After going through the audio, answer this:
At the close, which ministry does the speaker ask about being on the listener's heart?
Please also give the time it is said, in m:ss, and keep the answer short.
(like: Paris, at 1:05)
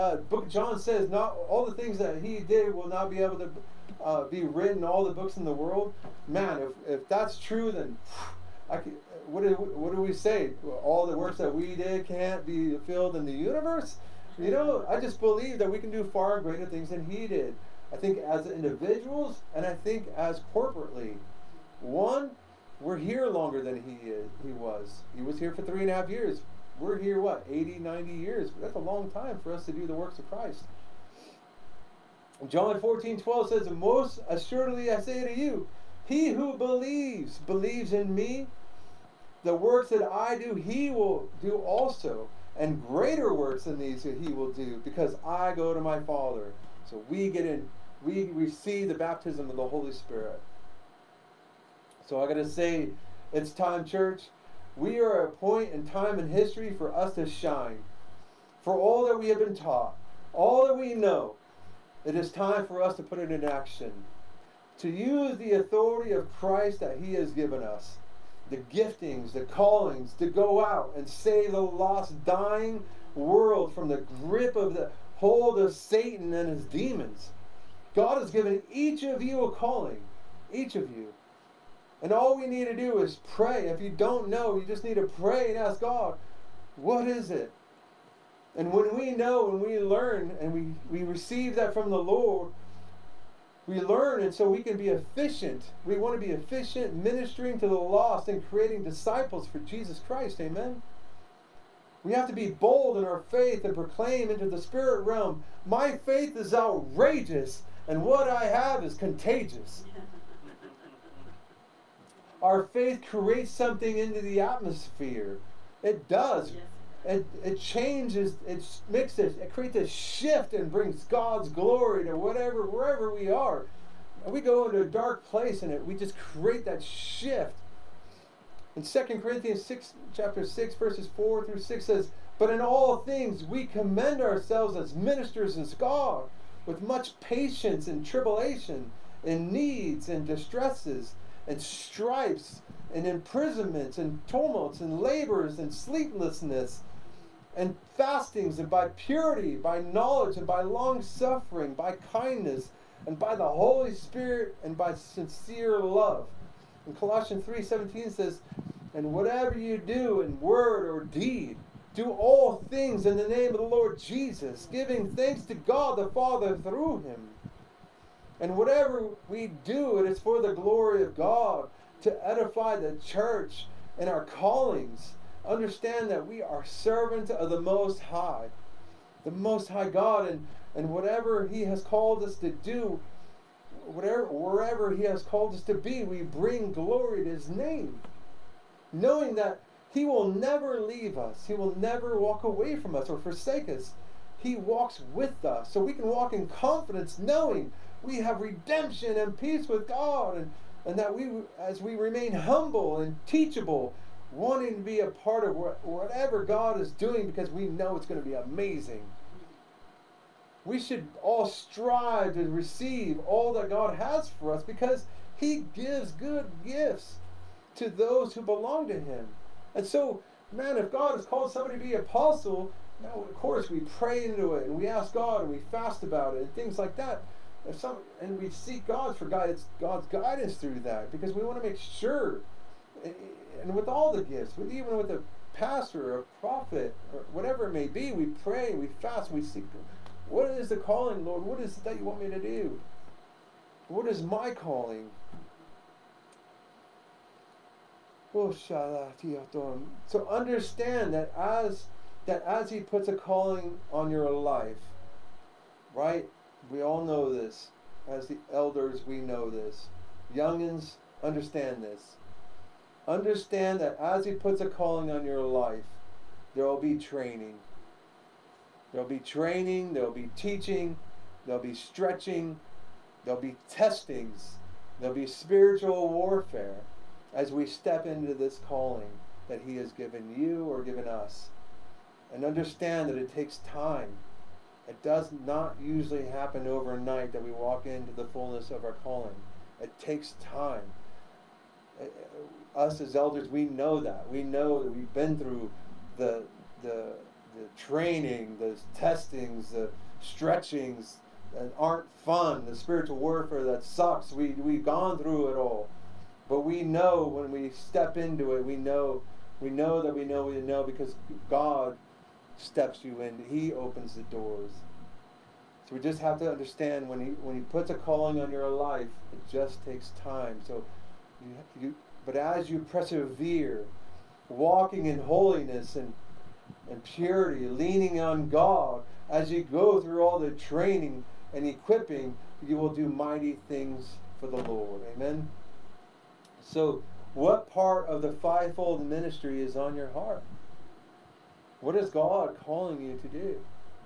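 Fivefold ministry, at 5:38.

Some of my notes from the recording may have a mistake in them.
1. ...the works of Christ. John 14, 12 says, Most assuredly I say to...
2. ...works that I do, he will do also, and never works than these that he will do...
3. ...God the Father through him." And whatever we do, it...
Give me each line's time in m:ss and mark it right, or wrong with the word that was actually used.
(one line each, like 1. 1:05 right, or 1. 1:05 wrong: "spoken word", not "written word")
1. 0:29 right
2. 0:39 wrong: "greater", not "never"
3. 2:45 right.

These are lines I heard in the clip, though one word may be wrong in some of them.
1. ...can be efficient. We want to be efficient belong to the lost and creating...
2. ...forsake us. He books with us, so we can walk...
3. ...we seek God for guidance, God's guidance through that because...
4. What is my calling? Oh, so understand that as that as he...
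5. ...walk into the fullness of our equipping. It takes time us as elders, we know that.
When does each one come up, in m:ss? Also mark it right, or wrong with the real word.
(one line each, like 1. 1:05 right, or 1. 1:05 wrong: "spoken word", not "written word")
1. 1:34 wrong: "ministering", not "belong"
2. 3:13 wrong: "walks", not "books"
3. 3:48 right
4. 4:03 right
5. 4:47 wrong: "calling", not "equipping".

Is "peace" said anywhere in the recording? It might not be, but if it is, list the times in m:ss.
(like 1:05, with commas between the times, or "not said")
3:19.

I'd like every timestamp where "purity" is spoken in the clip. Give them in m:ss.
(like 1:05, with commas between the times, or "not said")
2:28, 5:27.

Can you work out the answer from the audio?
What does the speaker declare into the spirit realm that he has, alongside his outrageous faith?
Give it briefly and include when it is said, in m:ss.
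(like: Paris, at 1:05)
Contagious, at 1:48.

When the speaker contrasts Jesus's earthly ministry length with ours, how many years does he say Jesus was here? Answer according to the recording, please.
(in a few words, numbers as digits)
3.5 years.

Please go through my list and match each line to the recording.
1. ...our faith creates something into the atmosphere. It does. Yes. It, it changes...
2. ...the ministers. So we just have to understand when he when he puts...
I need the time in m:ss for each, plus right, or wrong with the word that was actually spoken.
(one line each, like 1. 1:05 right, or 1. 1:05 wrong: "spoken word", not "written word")
1. 1:52 right
2. 5:14 wrong: "doors", not "ministers".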